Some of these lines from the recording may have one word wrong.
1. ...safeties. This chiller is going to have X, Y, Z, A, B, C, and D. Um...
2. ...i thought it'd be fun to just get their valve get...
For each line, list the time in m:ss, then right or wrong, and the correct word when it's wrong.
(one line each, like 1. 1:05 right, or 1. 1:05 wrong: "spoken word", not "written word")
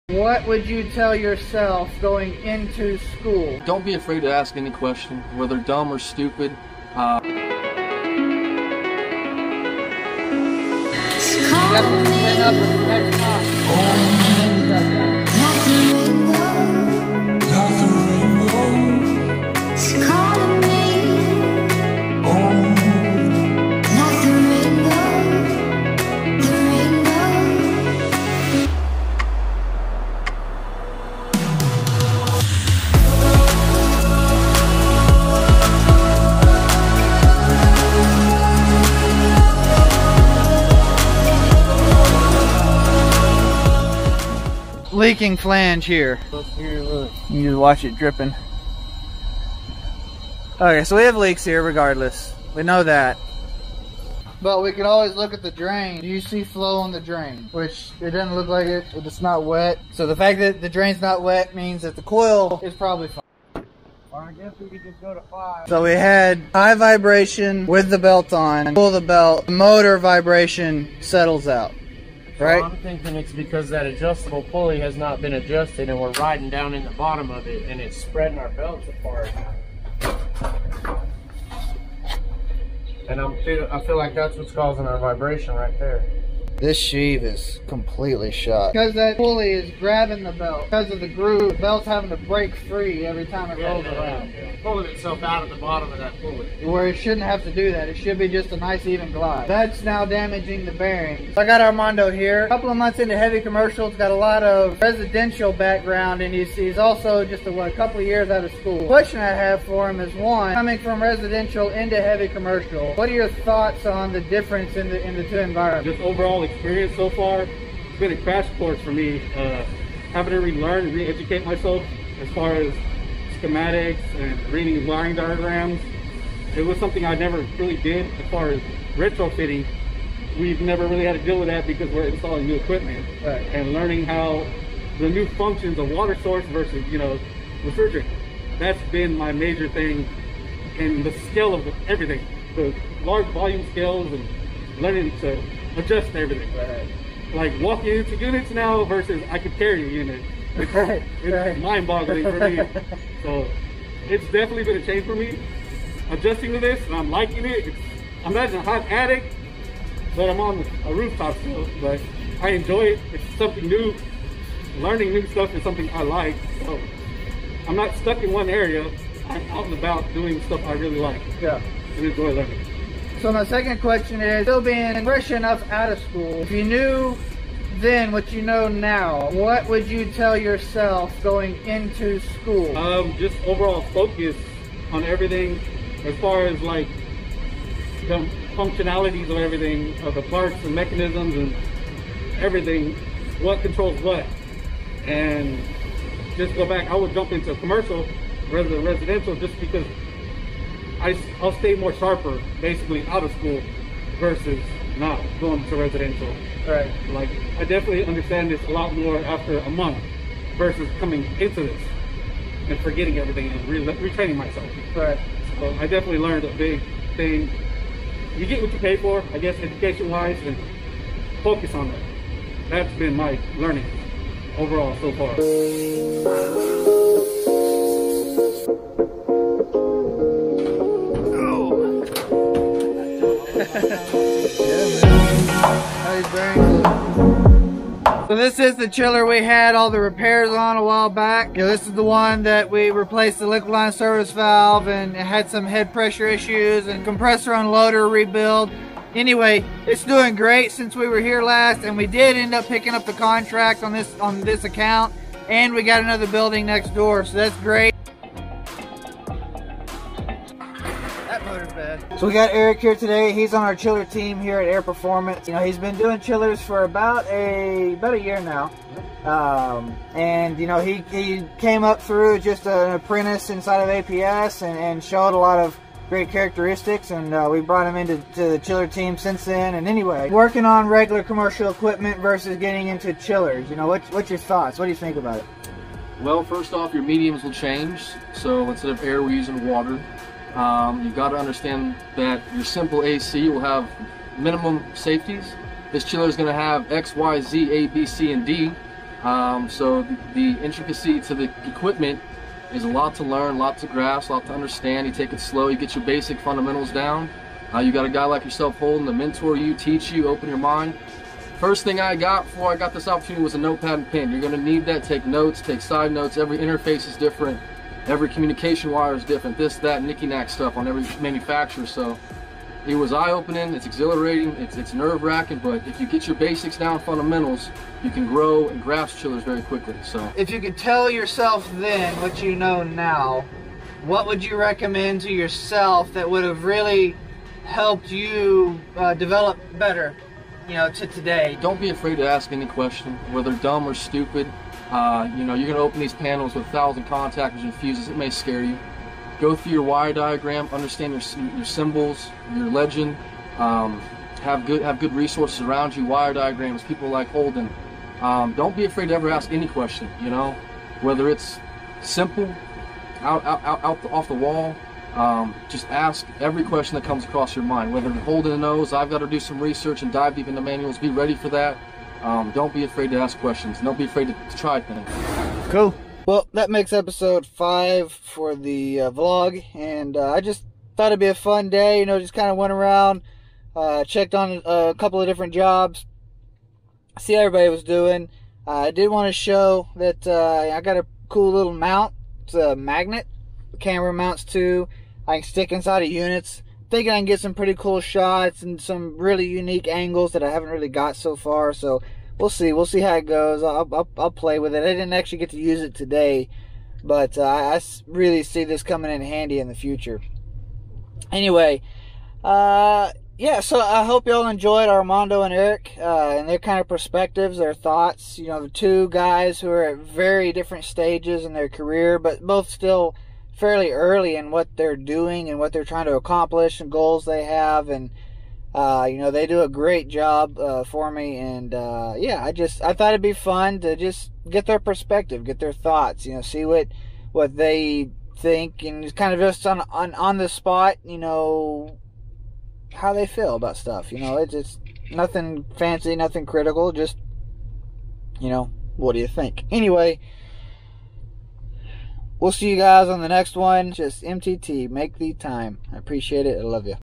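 1. 4:54 right
2. 7:12 wrong: "perspective", not "valve".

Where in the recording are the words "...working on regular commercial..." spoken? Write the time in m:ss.
4:40.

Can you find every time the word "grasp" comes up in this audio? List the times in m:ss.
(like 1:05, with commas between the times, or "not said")
5:03, 5:28.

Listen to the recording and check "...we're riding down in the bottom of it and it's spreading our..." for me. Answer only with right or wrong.
right.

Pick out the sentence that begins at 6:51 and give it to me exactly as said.
Anyway, uh, yeah, so I hope y'all enjoyed Armando and Eric uh, and their kind of perspectives, their thoughts.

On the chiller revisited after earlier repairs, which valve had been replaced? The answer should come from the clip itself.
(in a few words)
liquid line service valve.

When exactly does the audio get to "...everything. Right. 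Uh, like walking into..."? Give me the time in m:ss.
2:26.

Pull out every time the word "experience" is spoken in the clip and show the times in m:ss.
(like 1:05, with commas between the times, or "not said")
1:56.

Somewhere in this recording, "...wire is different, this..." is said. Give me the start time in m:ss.
5:18.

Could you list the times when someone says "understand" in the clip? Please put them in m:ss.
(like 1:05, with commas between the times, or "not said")
3:28, 4:51, 5:04, 5:50.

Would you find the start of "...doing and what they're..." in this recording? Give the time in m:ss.
7:04.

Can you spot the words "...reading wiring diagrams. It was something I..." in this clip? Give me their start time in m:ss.
2:04.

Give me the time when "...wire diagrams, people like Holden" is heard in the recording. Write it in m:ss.
5:56.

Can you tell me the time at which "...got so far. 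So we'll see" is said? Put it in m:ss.
6:40.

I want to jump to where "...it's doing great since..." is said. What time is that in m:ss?
4:09.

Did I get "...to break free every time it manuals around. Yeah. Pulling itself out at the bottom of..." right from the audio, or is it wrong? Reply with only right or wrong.
wrong.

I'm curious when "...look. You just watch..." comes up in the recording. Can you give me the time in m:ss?
0:46.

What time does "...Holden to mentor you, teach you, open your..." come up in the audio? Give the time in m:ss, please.
5:08.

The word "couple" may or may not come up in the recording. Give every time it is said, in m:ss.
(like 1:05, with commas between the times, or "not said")
1:42, 1:47, 6:24.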